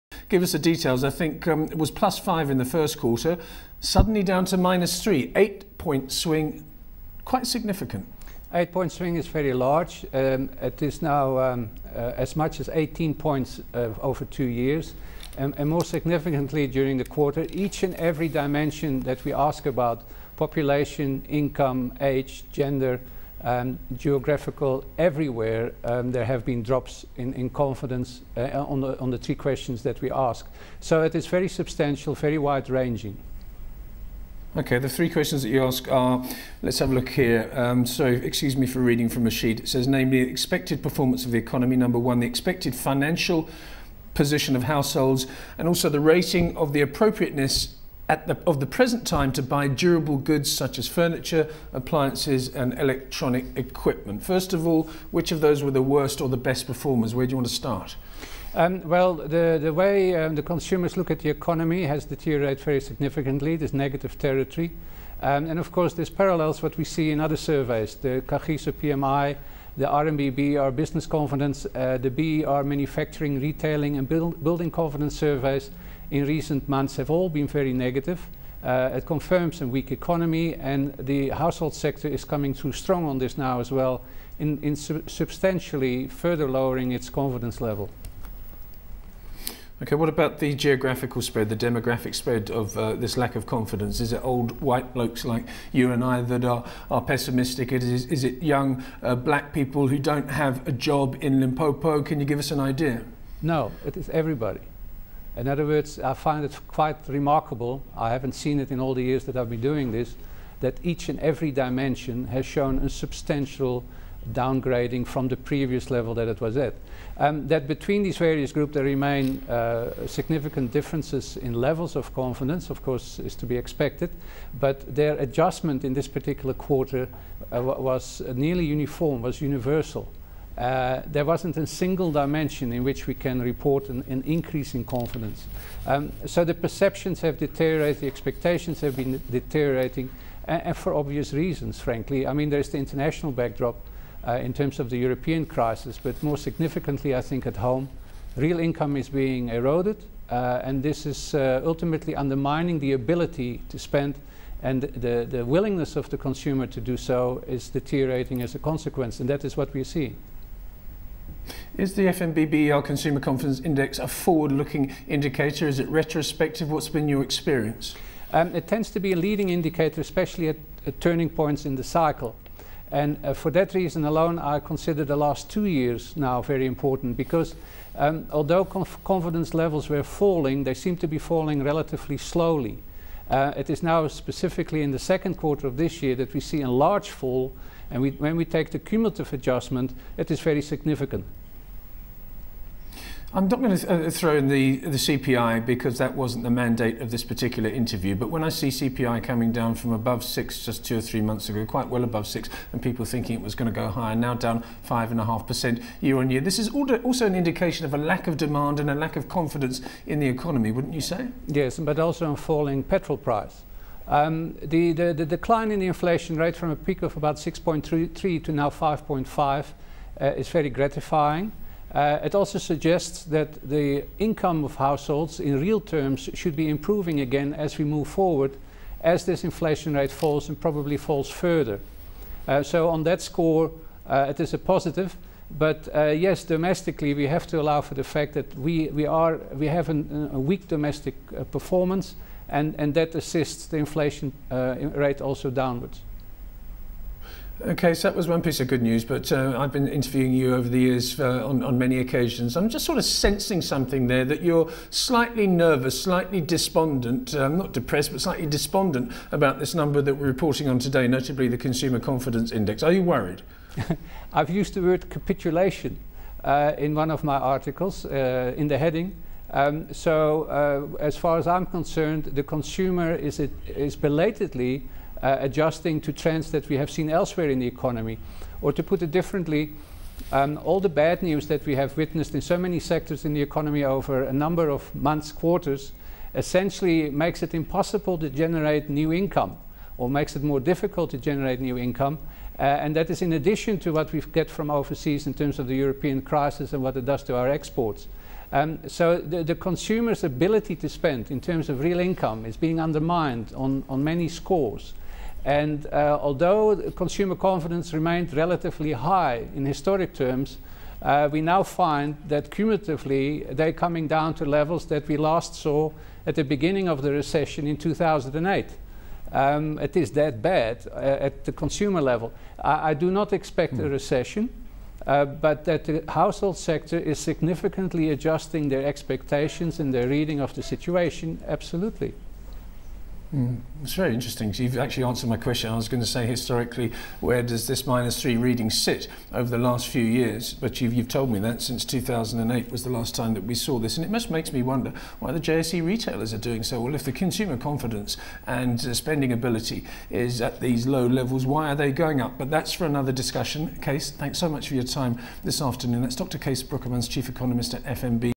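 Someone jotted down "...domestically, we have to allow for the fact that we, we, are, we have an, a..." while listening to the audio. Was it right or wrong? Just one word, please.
right.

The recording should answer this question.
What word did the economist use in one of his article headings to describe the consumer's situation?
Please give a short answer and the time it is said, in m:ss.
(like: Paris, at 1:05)
capitulation, at 4:25.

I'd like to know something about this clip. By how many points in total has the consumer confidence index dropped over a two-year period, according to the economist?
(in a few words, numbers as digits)
18.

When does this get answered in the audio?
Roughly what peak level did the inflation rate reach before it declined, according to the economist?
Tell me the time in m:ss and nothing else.
3:37.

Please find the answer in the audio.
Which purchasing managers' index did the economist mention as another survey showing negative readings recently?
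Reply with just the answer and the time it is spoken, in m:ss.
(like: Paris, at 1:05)
Kagiso PMI, at 1:07.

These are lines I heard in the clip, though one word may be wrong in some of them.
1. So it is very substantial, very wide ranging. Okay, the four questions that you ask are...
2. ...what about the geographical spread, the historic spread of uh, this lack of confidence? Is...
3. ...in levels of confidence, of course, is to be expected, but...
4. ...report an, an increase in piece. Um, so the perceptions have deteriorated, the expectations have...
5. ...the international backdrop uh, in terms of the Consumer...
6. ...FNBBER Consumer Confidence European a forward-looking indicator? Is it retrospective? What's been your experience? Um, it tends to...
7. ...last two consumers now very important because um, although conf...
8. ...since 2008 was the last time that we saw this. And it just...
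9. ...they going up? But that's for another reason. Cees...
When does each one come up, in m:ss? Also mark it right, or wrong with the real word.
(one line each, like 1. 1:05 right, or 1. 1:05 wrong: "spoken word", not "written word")
1. 0:30 wrong: "three", not "four"
2. 1:29 wrong: "demographic", not "historic"
3. 2:01 right
4. 2:13 wrong: "confidence", not "piece"
5. 2:22 wrong: "European", not "Consumer"
6. 2:42 wrong: "Index", not "European"
7. 2:55 wrong: "years", not "consumers"
8. 5:41 right
9. 5:51 wrong: "discussion", not "reason".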